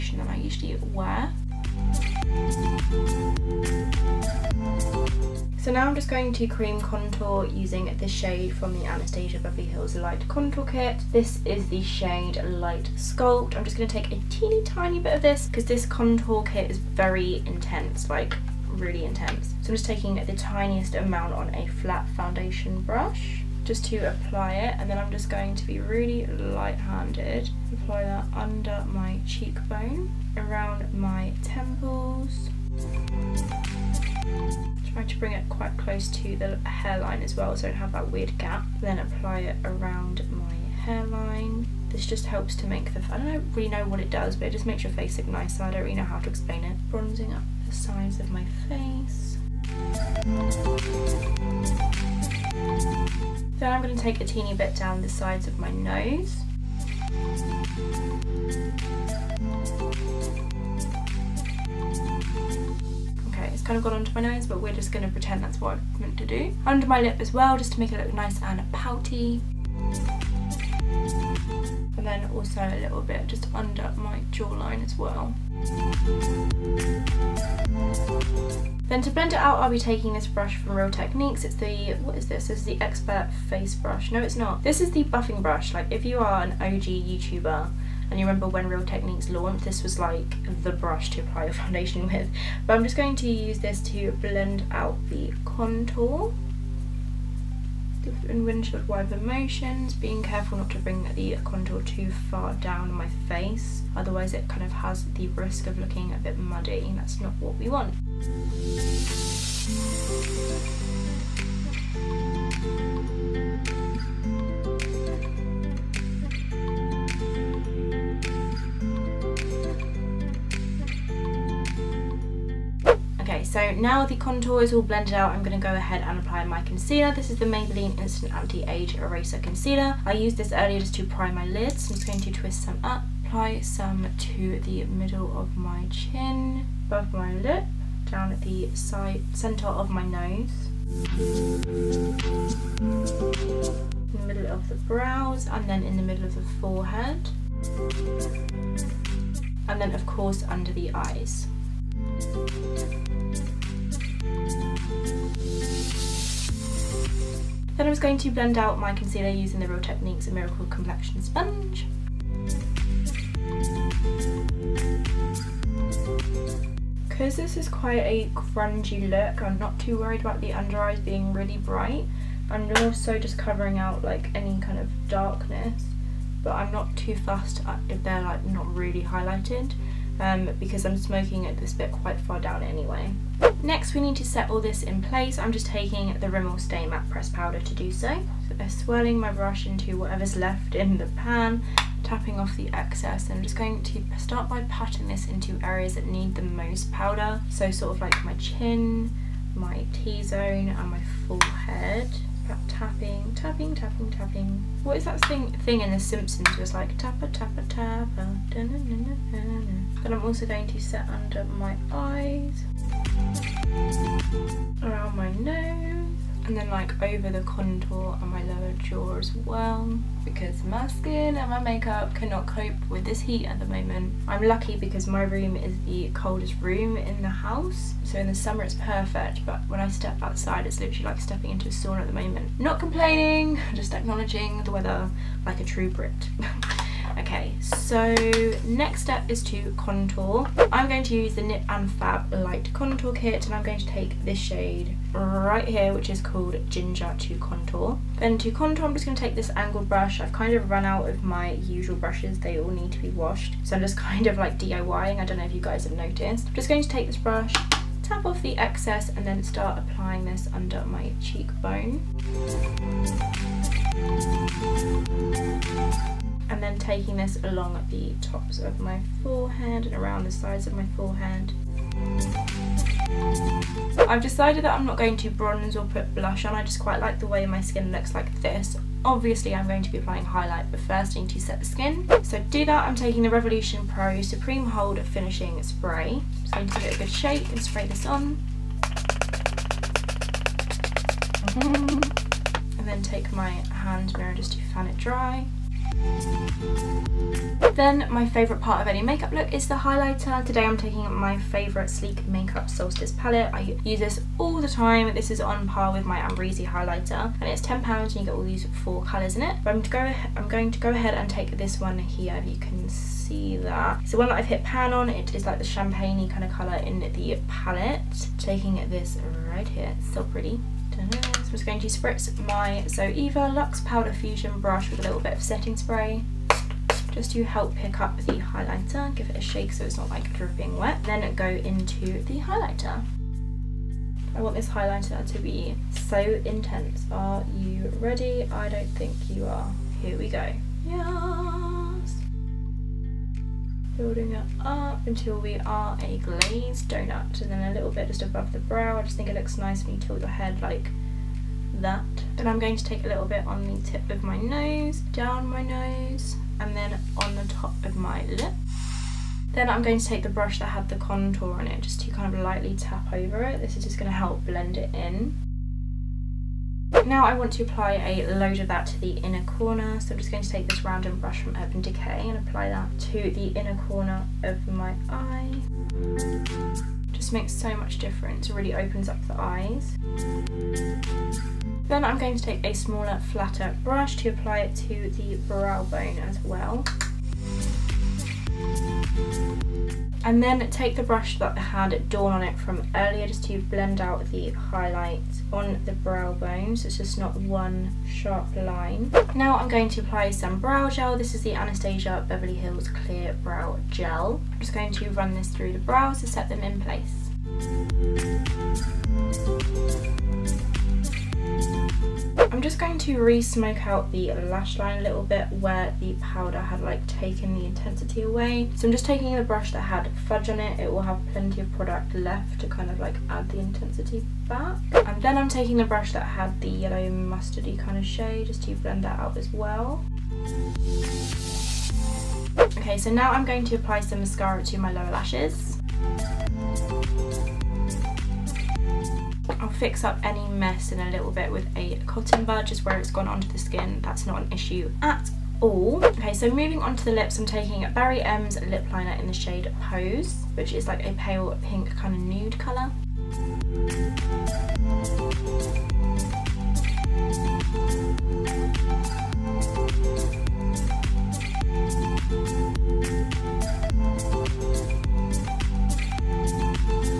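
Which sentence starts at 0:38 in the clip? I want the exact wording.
Then apply it around my hairline.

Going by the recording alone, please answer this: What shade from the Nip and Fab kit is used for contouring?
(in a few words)
Ginger.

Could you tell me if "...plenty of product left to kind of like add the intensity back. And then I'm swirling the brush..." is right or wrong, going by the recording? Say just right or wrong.
wrong.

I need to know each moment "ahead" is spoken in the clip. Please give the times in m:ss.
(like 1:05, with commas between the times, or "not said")
2:05, 5:10.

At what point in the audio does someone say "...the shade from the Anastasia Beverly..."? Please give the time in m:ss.
0:07.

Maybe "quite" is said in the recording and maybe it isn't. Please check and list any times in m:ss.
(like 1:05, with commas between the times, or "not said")
0:35, 2:47, 3:01, 4:36.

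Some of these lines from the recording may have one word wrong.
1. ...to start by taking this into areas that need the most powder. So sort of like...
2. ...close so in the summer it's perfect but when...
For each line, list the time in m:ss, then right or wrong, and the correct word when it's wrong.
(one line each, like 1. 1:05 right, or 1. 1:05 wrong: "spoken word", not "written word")
1. 3:13 wrong: "patting", not "taking"
2. 3:47 wrong: "house", not "close".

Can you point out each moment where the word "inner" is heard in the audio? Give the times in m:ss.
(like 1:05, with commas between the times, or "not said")
6:09, 6:13.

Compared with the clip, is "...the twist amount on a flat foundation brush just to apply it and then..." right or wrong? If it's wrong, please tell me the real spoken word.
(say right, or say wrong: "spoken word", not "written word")
wrong: "tiniest", not "twist".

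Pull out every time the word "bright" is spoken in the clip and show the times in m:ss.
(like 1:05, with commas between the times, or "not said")
2:51.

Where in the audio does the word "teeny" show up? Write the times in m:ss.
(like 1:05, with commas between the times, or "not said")
0:14, 0:54.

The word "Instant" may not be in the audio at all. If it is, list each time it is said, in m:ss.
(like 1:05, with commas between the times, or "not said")
2:07.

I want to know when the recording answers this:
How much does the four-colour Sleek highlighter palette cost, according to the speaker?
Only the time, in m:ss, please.
5:07.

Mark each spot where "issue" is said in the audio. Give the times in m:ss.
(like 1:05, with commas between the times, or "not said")
7:24.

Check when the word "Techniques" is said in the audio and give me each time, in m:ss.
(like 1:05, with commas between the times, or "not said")
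1:20, 1:28, 2:39.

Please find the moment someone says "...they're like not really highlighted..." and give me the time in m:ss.
2:58.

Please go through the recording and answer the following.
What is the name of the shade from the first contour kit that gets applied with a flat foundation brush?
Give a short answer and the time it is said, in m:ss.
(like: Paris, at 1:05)
Light Sculpt, at 0:12.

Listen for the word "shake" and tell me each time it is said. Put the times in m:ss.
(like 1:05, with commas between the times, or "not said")
4:47, 5:29.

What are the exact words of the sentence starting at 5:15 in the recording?
It is like the champagne kind of colour in the palette.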